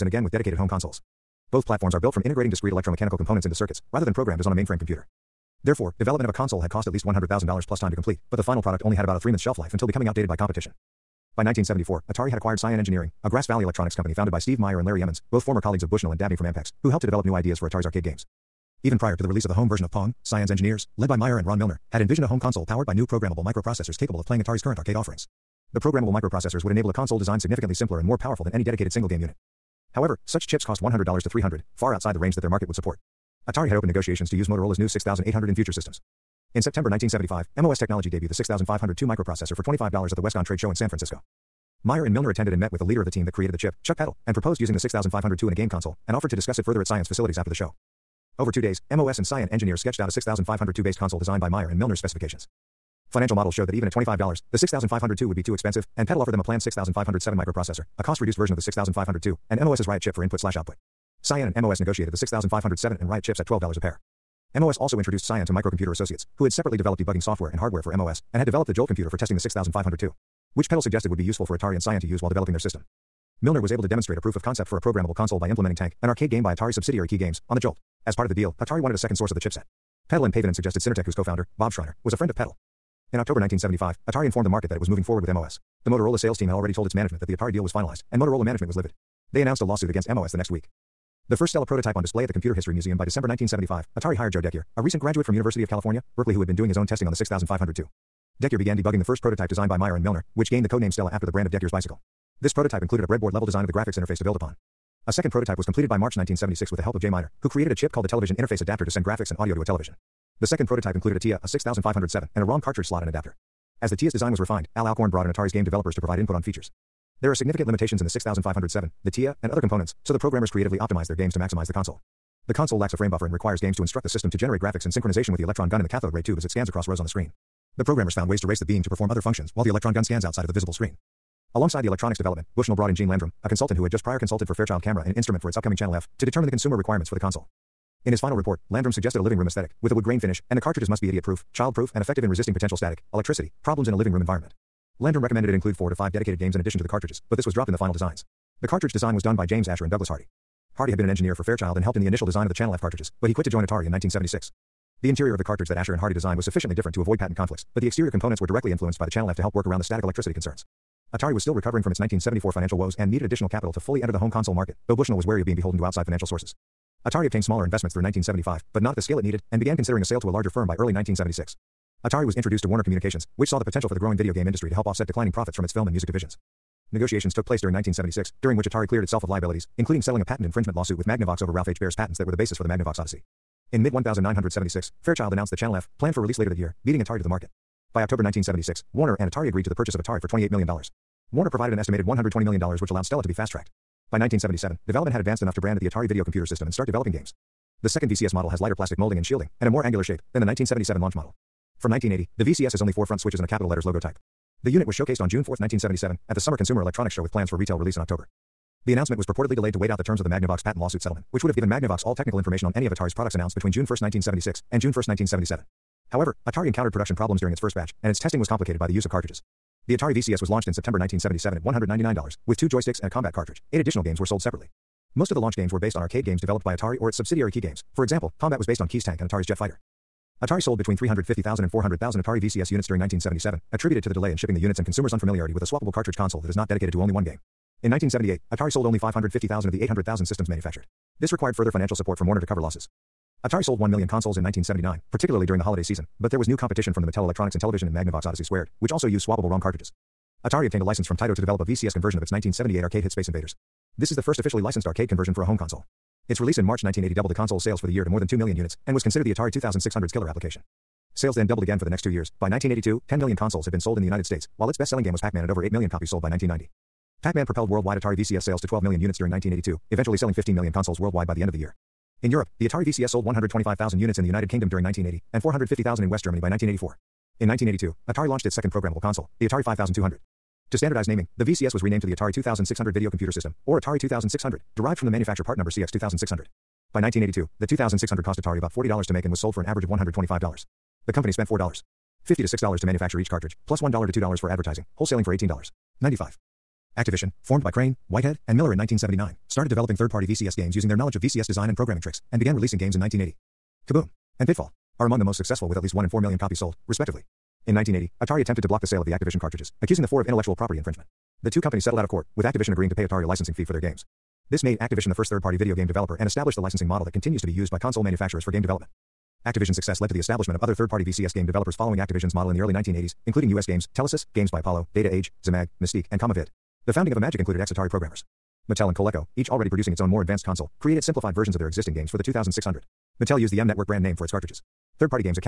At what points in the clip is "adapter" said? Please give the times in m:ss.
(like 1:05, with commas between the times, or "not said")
1:48, 1:53.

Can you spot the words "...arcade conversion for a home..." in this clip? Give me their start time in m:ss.
4:14.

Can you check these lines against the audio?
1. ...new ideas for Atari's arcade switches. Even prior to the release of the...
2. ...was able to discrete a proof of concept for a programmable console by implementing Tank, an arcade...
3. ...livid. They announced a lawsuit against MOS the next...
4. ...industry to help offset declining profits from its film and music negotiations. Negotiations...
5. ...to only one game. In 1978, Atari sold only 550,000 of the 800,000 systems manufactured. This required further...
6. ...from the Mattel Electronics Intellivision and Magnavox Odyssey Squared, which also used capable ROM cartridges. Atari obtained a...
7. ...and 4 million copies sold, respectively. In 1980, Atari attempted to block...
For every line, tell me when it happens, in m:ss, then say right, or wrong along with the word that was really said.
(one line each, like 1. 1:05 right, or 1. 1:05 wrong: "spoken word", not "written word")
1. 0:17 wrong: "games", not "switches"
2. 1:13 wrong: "demonstrate", not "discrete"
3. 1:28 right
4. 2:54 wrong: "divisions", not "negotiations"
5. 3:56 right
6. 4:06 wrong: "swappable", not "capable"
7. 5:06 right.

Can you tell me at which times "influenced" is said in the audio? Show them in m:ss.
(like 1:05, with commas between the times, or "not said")
2:38.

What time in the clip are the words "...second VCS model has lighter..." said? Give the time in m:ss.
3:17.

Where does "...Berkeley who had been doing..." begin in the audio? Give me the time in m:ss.
1:36.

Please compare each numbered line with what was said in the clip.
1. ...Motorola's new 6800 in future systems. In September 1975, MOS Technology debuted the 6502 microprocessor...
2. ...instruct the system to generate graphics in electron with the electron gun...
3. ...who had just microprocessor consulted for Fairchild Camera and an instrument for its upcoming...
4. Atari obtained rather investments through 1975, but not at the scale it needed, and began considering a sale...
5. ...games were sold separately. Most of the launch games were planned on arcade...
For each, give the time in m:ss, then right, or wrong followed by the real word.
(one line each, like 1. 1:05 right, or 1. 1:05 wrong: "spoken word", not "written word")
1. 0:34 right
2. 2:03 wrong: "synchronization", not "electron"
3. 2:13 wrong: "prior", not "microprocessor"
4. 2:47 wrong: "smaller", not "rather"
5. 3:44 wrong: "based", not "planned".